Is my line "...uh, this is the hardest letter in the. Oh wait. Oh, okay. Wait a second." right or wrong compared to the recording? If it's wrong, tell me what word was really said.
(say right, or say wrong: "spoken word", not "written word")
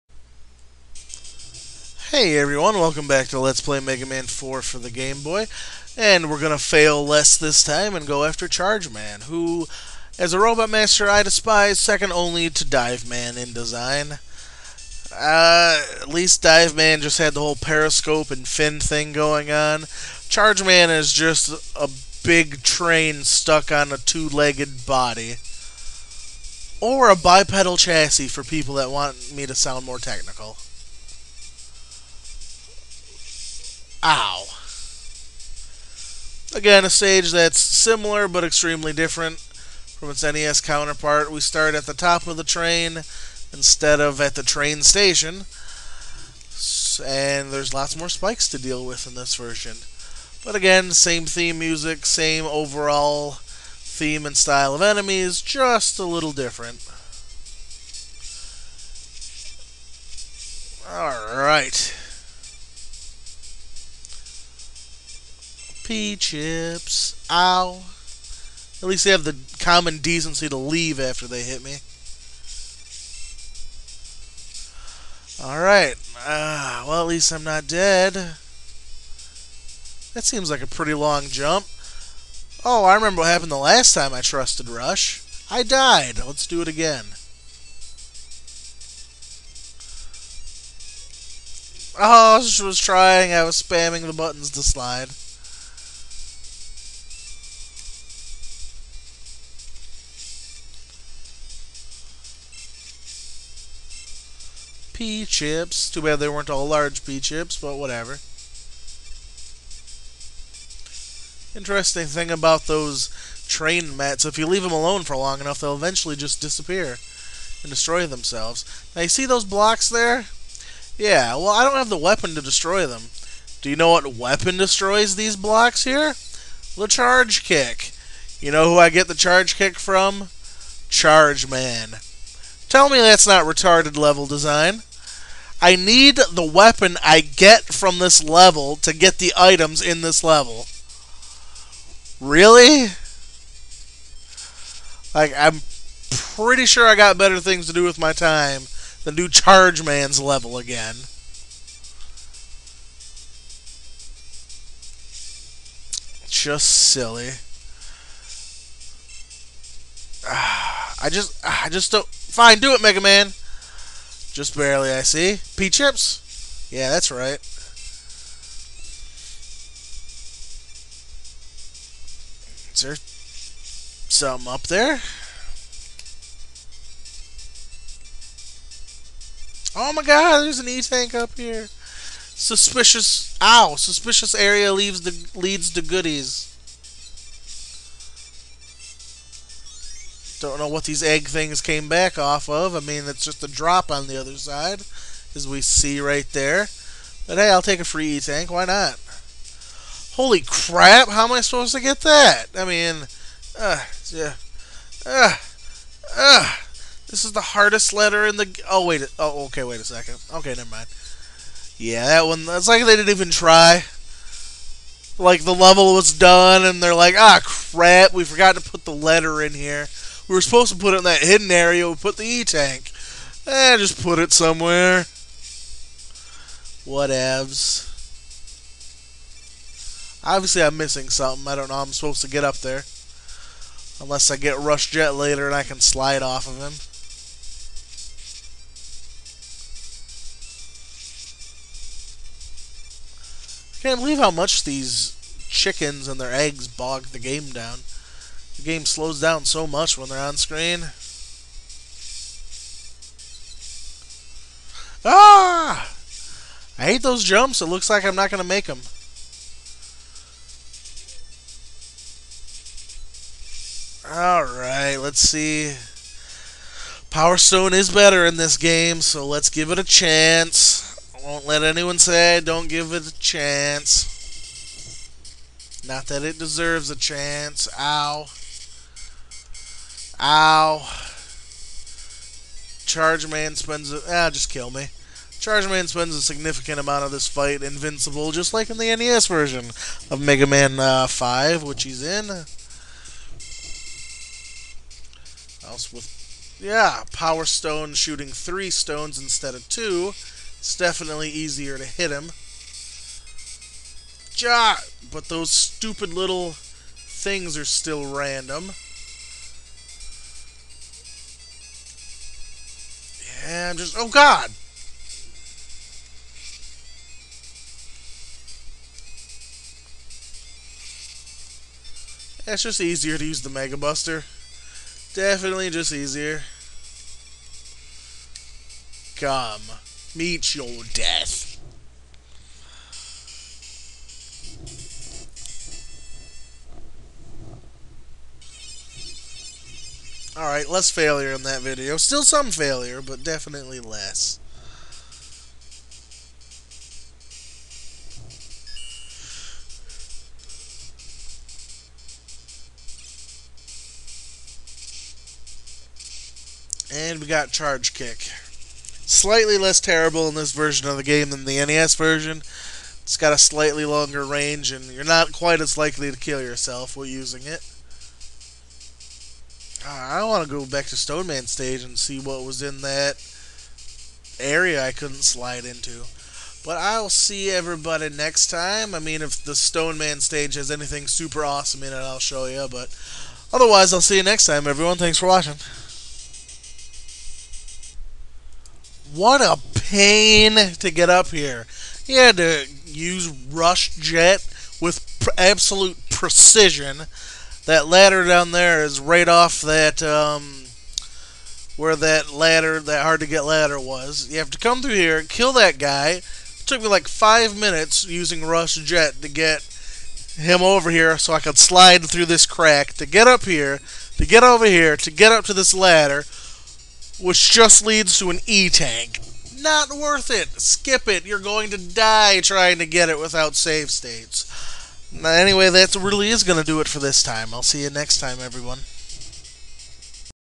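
right.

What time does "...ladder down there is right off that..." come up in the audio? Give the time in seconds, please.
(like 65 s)
397 s.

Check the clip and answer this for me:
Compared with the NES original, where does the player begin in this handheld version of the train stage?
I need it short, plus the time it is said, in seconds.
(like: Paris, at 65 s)
the top of the train, at 41 s.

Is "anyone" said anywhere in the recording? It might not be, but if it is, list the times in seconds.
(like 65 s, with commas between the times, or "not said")
271 s.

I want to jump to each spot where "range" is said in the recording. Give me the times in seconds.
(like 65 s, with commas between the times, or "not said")
364 s.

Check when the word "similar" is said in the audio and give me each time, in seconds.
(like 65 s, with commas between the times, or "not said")
37 s.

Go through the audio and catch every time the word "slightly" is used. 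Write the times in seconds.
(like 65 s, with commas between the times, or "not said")
359 s, 363 s.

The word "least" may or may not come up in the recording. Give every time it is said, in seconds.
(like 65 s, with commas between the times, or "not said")
16 s, 68 s, 77 s.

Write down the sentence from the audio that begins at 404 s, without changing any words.
You have to come through here, kill that guy.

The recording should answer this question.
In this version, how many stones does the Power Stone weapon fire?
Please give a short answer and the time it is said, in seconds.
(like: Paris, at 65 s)
3, at 298 s.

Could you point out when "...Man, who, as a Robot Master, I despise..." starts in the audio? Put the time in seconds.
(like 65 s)
8 s.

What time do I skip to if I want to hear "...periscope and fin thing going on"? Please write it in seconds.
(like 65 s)
17 s.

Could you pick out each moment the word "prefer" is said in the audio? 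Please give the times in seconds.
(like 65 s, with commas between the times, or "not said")
not said.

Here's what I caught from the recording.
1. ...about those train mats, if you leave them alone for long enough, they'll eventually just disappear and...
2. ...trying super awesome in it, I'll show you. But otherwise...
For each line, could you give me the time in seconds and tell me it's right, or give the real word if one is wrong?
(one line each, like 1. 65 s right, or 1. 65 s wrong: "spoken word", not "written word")
1. 112 s right
2. 380 s wrong: "anything", not "trying".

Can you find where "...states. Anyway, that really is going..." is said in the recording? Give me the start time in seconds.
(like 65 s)
423 s.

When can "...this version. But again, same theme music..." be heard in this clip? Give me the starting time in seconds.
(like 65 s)
49 s.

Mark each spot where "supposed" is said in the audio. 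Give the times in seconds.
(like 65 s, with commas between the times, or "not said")
201 s, 220 s, 231 s.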